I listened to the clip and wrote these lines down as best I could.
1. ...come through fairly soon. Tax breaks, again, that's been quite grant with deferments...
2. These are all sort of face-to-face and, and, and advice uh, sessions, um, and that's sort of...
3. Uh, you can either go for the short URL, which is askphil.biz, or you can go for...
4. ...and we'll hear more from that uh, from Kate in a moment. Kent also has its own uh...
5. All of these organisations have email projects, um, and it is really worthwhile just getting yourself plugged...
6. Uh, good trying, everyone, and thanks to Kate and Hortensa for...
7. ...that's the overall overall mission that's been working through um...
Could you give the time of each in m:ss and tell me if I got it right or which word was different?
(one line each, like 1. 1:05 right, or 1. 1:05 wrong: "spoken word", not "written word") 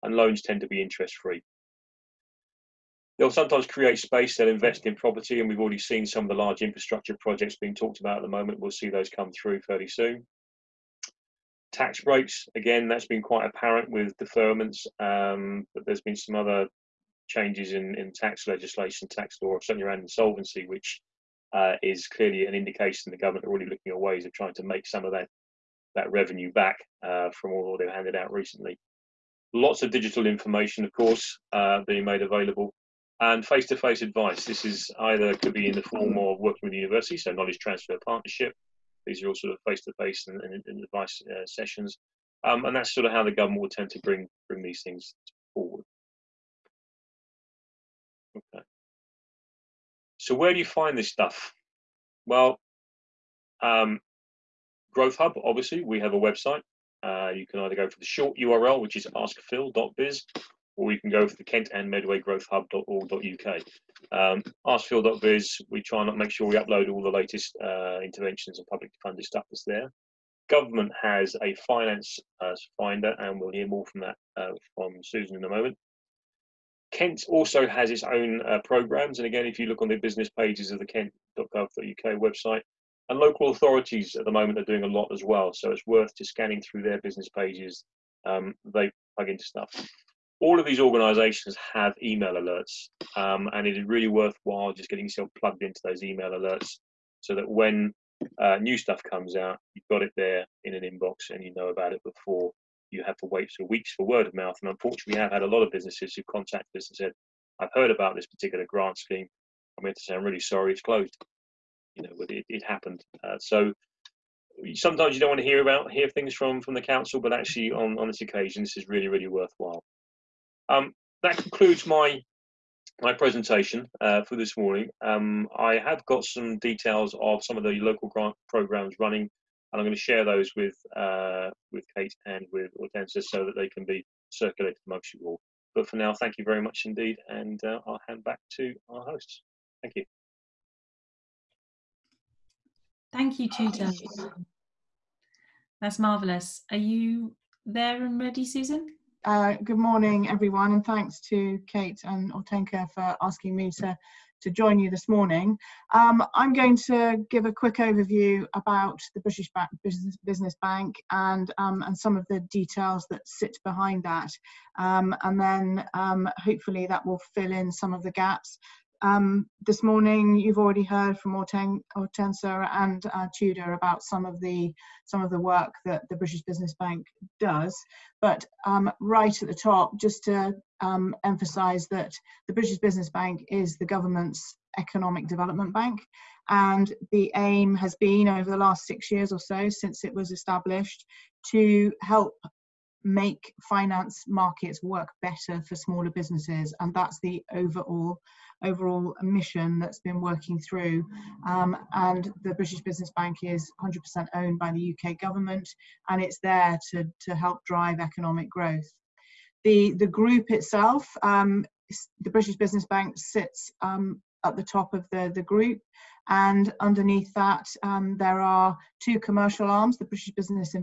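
1. 0:09 wrong: "apparent", not "grant"
2. 0:39 right
3. 0:57 right
4. 1:13 wrong: "Susan", not "Kate"
5. 1:30 wrong: "alerts", not "projects"
6. 2:29 wrong: "morning", not "trying"
7. 3:16 right.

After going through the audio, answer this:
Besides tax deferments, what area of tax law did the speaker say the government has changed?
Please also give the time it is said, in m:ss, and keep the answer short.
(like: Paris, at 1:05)
Insolvency, at 0:20.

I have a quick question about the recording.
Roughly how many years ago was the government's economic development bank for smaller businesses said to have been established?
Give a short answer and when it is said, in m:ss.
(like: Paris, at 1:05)
6, at 3:08.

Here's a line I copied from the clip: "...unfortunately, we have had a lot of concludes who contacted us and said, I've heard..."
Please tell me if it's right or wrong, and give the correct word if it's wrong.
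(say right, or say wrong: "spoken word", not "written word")
wrong: "businesses", not "concludes".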